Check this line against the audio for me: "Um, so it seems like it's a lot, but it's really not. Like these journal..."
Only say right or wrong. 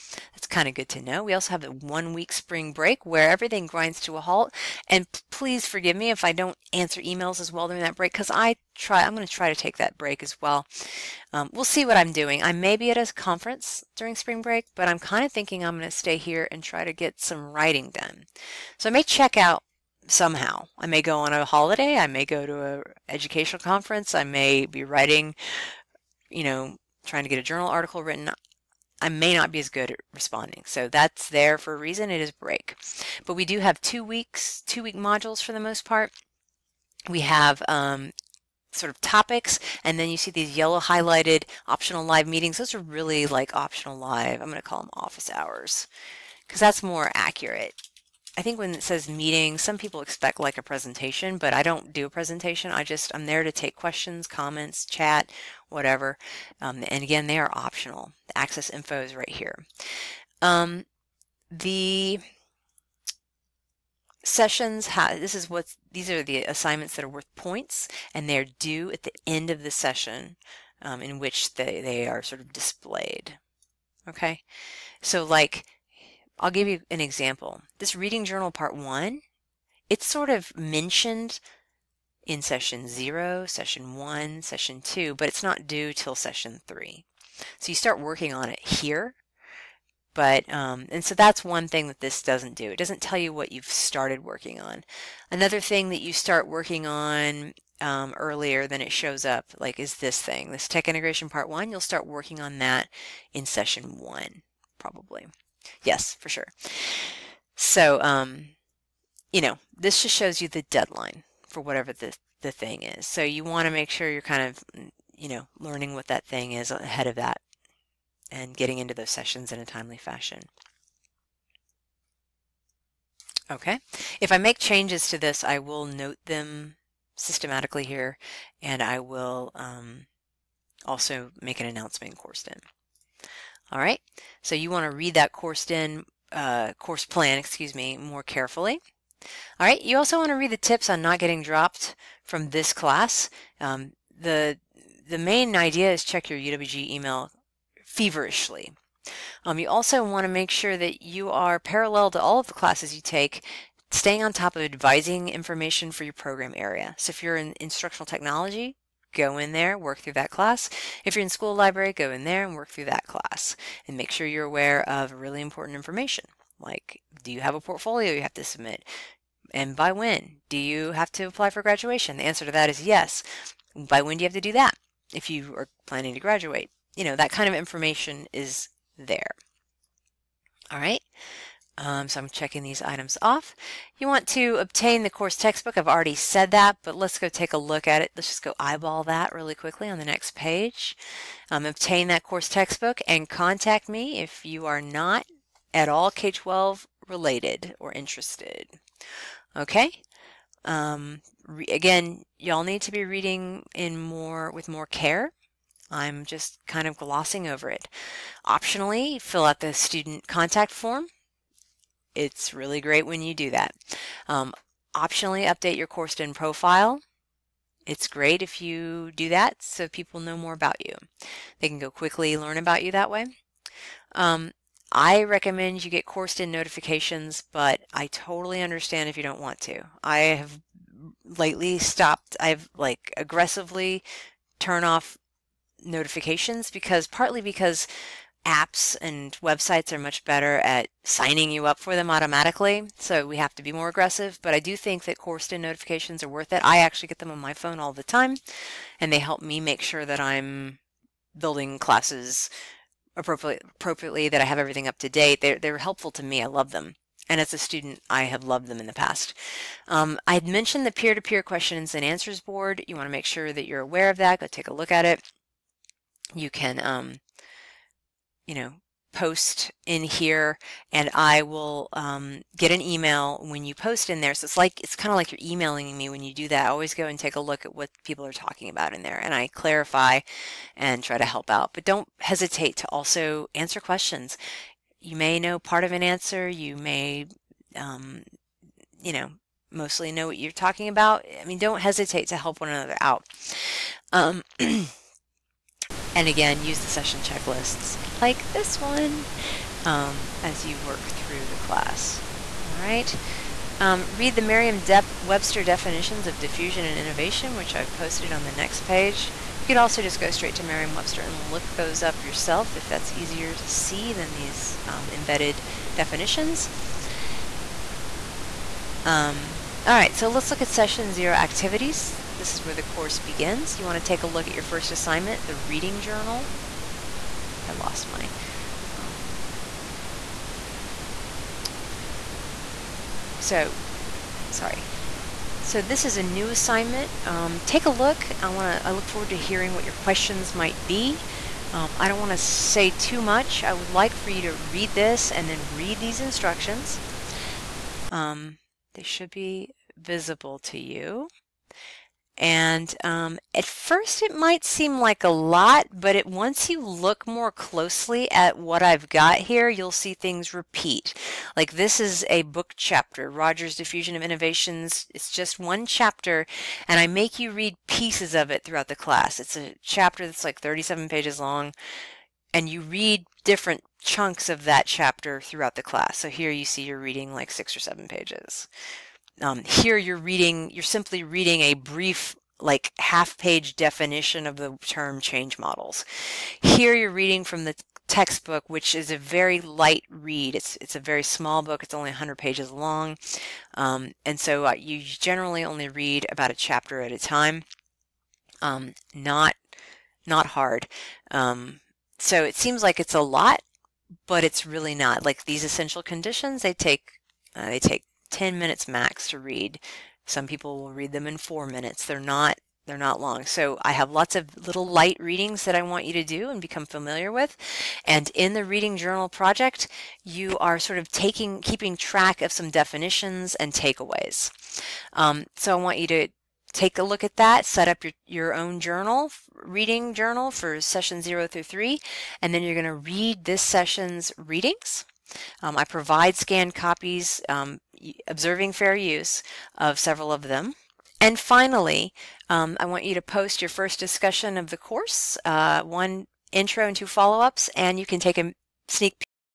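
wrong.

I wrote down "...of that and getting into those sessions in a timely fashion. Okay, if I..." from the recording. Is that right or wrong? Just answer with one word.
right.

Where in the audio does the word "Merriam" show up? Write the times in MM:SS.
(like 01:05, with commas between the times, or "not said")
05:04, 05:10.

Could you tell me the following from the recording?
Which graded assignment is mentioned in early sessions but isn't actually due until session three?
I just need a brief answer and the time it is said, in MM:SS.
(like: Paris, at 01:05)
Reading journal part one, at 01:17.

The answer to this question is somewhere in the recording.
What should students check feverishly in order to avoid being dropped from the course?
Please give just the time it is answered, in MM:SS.
02:26.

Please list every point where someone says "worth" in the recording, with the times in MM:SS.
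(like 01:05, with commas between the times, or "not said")
01:07, 04:06.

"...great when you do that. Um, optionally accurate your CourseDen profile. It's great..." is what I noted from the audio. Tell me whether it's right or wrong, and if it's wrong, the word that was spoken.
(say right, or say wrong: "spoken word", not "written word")
wrong: "update", not "accurate".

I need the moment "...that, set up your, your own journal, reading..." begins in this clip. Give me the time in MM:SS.
07:07.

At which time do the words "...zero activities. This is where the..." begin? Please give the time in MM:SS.
05:21.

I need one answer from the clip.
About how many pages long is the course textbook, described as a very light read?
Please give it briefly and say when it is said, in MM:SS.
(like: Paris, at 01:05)
100, at 06:32.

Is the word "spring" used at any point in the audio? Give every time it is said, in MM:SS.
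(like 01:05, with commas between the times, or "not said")
00:02, 00:14.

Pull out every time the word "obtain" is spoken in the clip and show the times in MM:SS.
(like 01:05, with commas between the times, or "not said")
03:04, 03:11.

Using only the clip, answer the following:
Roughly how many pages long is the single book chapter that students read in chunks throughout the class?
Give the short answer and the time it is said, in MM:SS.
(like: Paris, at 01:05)
37, at 06:10.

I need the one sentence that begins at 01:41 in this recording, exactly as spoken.
You'll start working on that in session one, probably.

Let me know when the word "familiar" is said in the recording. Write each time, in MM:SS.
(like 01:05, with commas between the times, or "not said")
06:56.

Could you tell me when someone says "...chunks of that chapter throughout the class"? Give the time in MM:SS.
06:13.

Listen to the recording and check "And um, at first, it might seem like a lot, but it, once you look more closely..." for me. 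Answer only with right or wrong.
right.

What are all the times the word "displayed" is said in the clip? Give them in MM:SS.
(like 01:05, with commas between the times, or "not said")
01:12.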